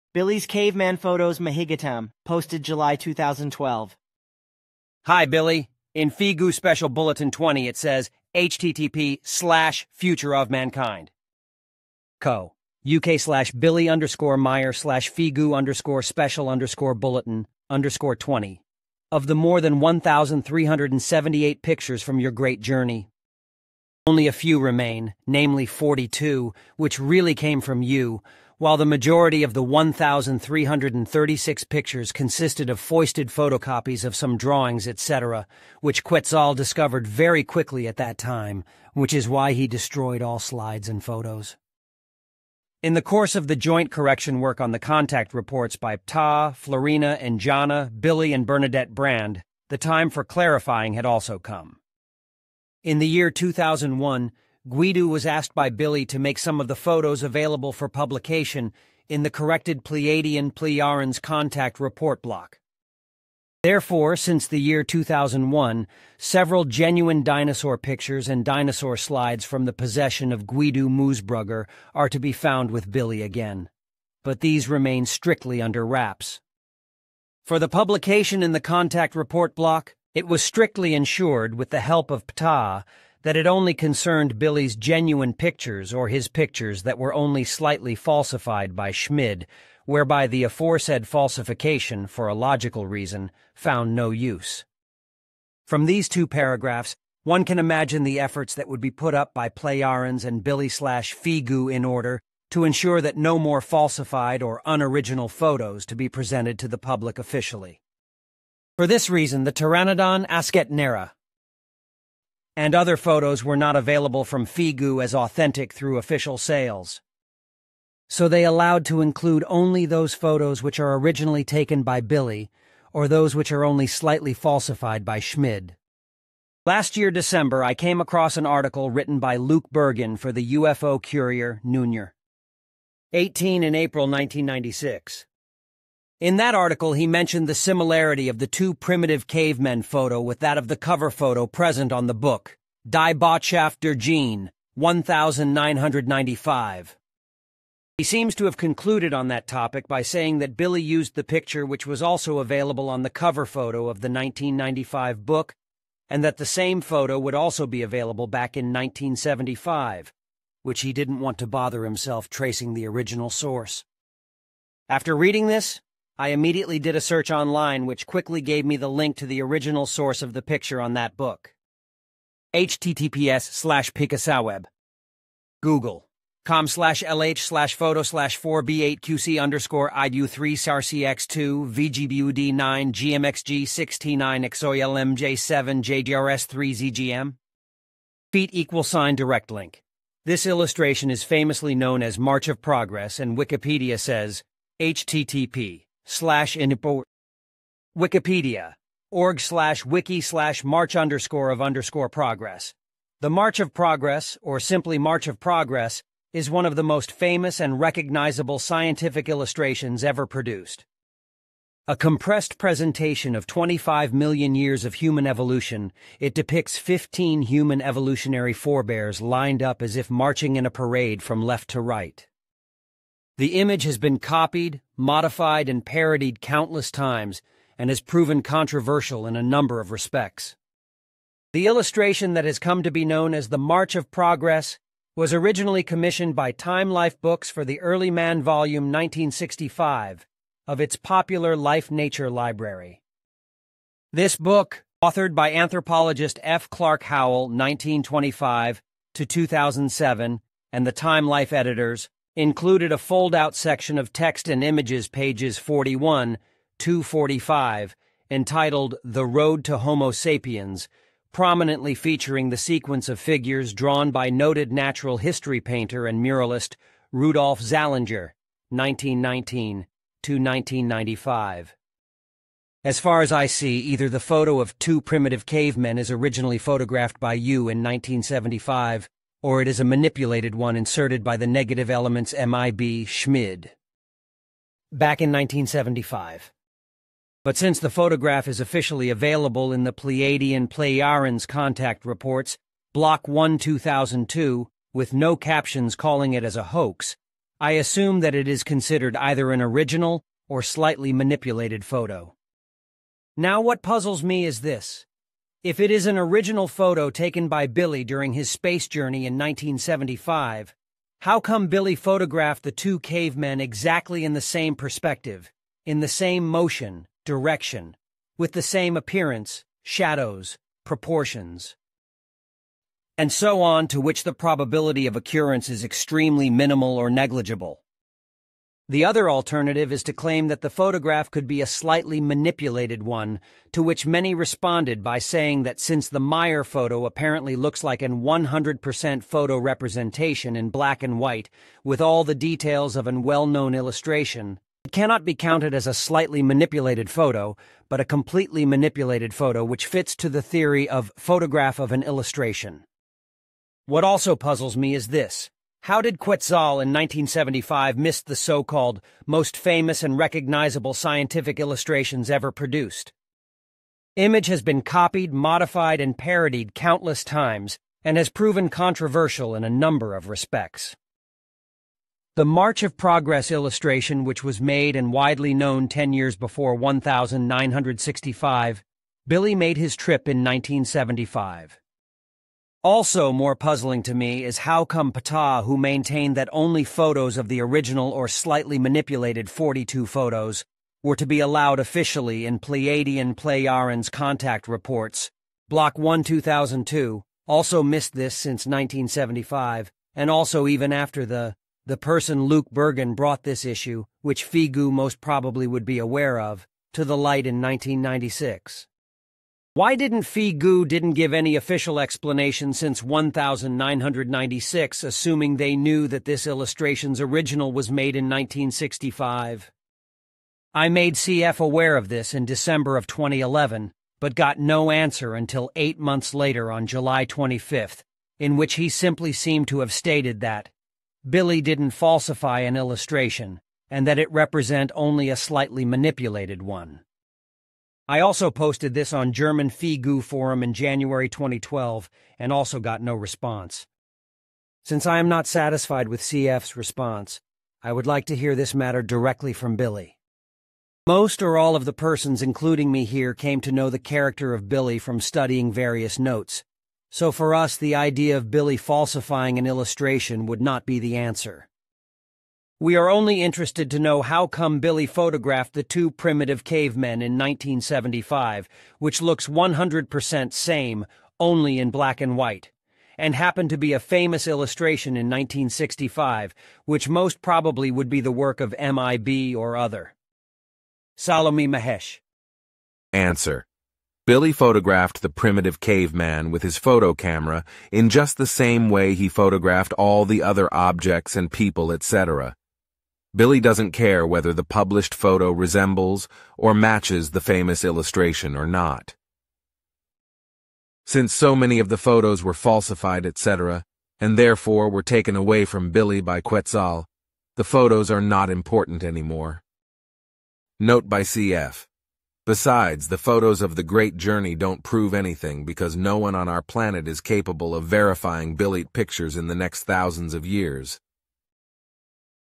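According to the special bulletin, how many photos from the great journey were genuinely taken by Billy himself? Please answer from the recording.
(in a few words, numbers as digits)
42.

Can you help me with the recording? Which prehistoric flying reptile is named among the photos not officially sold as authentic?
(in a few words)
Pteranodon.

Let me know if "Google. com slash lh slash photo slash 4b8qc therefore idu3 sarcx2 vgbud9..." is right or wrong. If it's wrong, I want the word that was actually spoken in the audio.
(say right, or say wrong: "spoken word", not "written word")
wrong: "underscore", not "therefore".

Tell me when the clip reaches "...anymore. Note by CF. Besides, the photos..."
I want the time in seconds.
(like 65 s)
509 s.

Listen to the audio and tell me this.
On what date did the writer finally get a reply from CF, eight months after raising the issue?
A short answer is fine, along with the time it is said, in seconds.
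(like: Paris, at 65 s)
July 25th, at 426 s.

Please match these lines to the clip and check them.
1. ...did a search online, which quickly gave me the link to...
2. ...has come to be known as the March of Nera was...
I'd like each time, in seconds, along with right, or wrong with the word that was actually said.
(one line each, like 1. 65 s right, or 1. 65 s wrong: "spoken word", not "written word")
1. 166 s right
2. 232 s wrong: "Progress", not "Nera".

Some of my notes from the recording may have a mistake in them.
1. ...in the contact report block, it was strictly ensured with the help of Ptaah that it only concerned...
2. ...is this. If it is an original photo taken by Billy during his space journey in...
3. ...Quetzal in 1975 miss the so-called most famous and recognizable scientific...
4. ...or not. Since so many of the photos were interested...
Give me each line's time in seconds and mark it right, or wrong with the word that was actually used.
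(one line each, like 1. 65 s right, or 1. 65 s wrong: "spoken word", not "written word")
1. 78 s right
2. 304 s right
3. 356 s right
4. 498 s wrong: "falsified", not "interested".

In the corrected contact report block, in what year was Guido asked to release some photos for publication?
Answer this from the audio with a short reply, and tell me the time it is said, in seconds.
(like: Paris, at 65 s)
2001, at 52 s.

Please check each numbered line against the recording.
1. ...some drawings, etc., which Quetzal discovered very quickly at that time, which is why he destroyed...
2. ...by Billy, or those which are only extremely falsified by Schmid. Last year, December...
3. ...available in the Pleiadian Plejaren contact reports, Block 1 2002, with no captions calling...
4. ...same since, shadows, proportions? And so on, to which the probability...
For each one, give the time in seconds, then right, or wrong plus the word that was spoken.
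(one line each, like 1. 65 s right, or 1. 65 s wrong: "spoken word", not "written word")
1. 34 s right
2. 121 s wrong: "slightly", not "extremely"
3. 289 s right
4. 318 s wrong: "appearance", not "since".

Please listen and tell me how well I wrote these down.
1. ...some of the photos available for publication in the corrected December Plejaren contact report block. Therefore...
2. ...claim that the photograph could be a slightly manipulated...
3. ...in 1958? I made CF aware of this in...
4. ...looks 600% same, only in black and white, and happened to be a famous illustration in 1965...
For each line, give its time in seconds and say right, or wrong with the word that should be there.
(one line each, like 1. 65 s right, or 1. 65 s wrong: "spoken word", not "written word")
1. 56 s wrong: "Pleiadian", not "December"
2. 330 s right
3. 418 s wrong: "1965", not "1958"
4. 469 s wrong: "100", not "600".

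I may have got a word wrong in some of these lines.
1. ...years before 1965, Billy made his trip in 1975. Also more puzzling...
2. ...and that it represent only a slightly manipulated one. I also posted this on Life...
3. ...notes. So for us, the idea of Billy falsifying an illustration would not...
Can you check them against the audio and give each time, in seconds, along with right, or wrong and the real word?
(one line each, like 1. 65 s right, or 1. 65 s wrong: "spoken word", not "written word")
1. 376 s right
2. 433 s wrong: "German", not "Life"
3. 456 s right.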